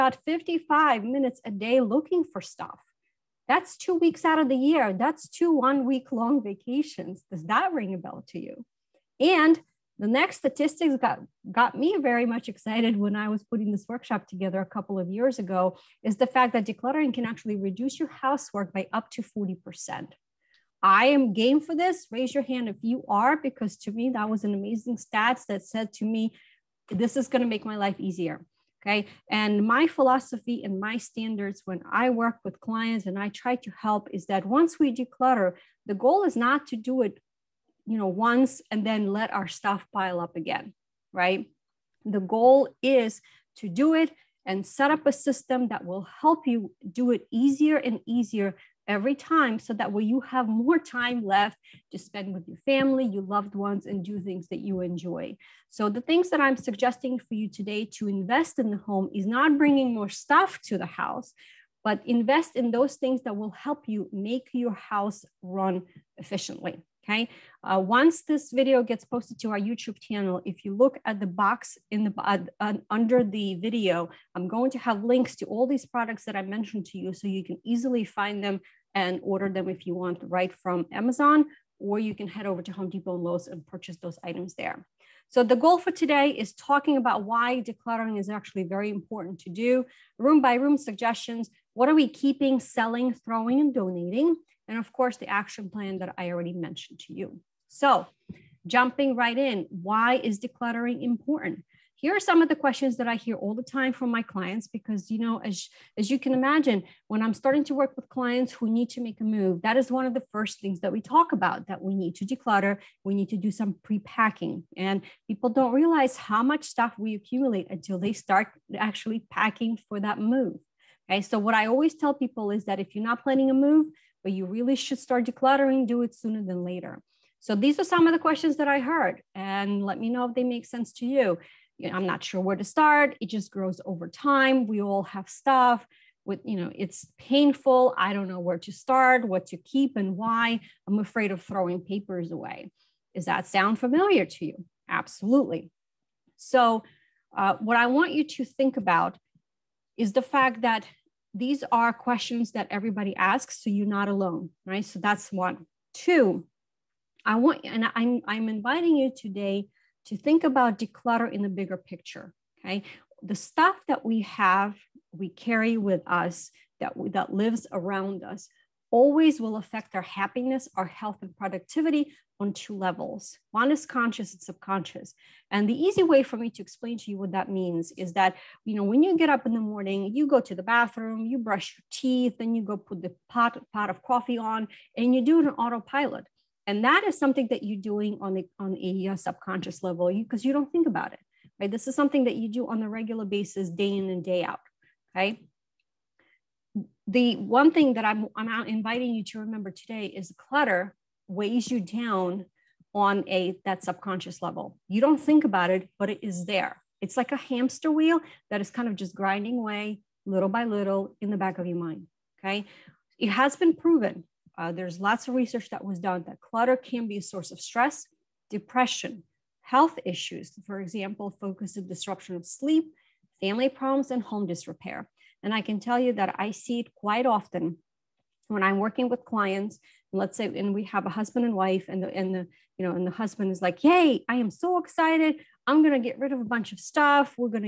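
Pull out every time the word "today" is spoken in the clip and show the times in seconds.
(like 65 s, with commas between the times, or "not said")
57 s, 85 s, 159 s, 199 s.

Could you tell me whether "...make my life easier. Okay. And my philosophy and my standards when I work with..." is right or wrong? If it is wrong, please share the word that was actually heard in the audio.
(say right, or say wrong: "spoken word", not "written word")
right.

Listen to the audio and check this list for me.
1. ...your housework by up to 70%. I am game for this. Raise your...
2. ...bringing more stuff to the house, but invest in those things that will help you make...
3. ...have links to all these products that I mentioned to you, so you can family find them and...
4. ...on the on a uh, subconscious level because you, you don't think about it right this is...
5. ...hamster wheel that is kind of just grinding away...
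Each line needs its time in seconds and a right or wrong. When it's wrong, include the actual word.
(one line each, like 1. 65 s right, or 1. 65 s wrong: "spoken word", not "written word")
1. 17 s wrong: "40", not "70"
2. 59 s right
3. 74 s wrong: "easily", not "family"
4. 188 s right
5. 207 s right.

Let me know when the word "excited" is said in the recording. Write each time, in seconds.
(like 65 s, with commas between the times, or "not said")
12 s, 234 s.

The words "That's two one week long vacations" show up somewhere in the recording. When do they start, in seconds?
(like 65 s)
4 s.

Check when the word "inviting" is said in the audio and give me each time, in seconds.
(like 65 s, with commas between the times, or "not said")
158 s, 198 s.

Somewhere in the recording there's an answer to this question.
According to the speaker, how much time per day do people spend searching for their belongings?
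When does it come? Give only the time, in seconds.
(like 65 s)
0 s.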